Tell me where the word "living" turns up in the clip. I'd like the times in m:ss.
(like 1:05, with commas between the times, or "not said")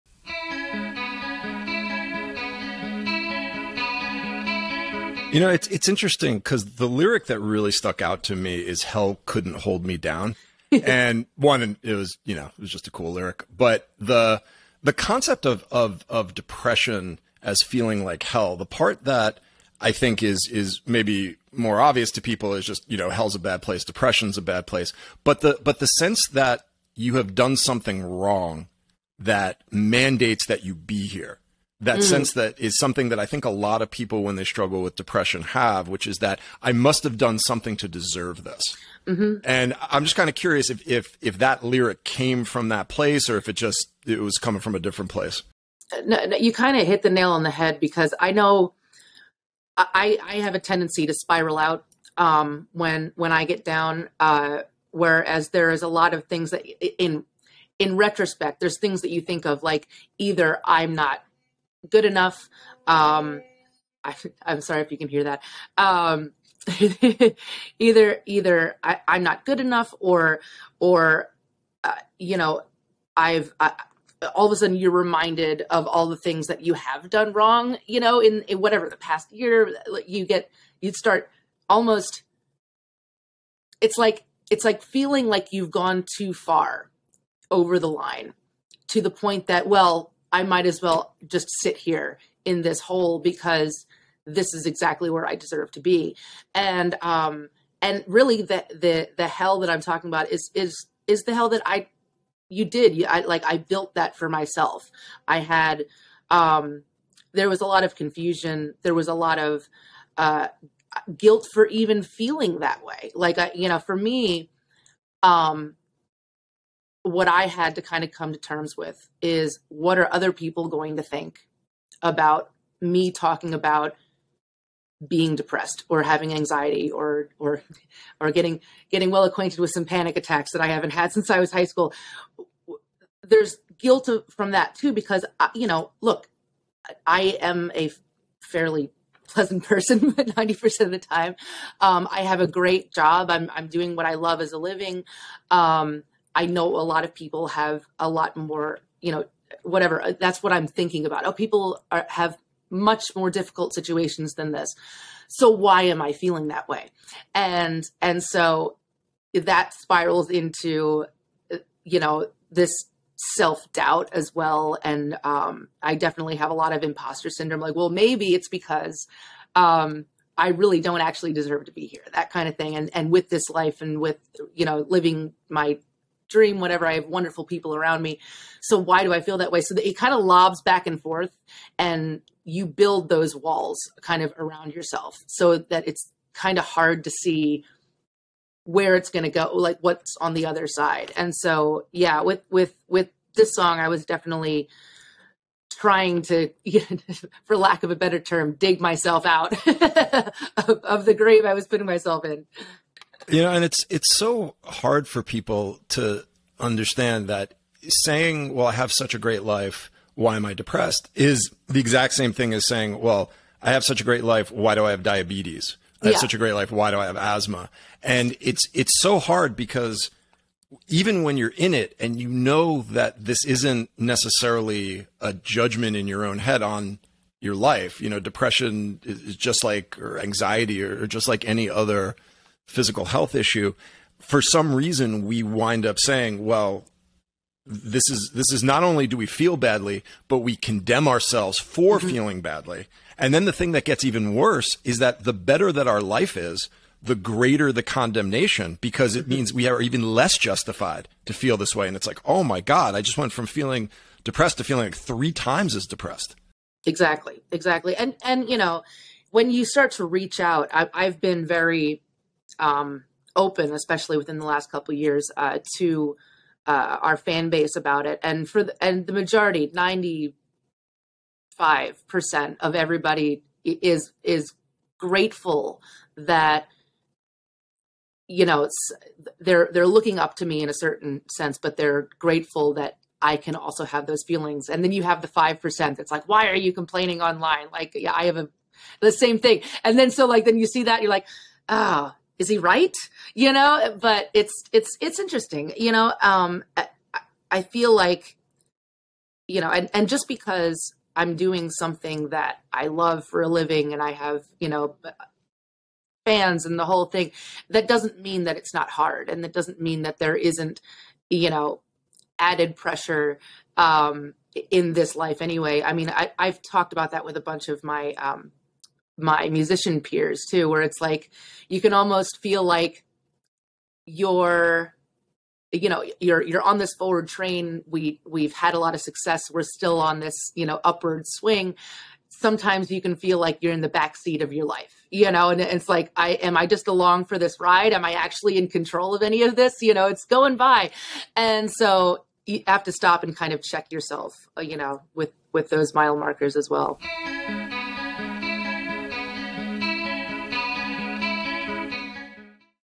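2:24, 2:54, 5:03.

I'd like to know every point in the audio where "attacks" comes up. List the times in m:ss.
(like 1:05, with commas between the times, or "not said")
2:10.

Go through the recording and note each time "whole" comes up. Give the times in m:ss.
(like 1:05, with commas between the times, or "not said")
5:06.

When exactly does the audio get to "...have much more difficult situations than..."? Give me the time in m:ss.
2:32.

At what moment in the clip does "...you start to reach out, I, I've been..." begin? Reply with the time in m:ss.
4:19.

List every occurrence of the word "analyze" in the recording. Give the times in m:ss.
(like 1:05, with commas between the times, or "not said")
not said.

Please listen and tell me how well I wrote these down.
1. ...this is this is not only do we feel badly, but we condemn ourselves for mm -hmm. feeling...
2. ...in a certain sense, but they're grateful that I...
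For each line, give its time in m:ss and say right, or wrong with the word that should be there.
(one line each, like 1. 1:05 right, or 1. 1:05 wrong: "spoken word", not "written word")
1. 3:57 right
2. 4:40 right.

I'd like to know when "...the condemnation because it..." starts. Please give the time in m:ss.
4:07.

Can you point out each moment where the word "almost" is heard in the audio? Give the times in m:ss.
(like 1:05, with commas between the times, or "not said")
1:21, 5:21.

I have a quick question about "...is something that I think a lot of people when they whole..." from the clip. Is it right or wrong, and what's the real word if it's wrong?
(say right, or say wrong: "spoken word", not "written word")
wrong: "struggle", not "whole".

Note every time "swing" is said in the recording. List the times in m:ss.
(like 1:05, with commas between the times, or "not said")
5:31.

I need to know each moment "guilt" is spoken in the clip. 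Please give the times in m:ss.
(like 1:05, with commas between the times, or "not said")
1:51, 2:13.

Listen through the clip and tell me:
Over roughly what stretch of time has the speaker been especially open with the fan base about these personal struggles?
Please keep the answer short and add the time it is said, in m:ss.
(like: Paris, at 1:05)
last couple years, at 4:24.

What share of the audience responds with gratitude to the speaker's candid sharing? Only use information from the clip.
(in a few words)
95 percent.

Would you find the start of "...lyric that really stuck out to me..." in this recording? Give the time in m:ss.
0:06.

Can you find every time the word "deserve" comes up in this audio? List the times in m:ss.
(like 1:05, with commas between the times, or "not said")
0:37, 1:35, 2:51.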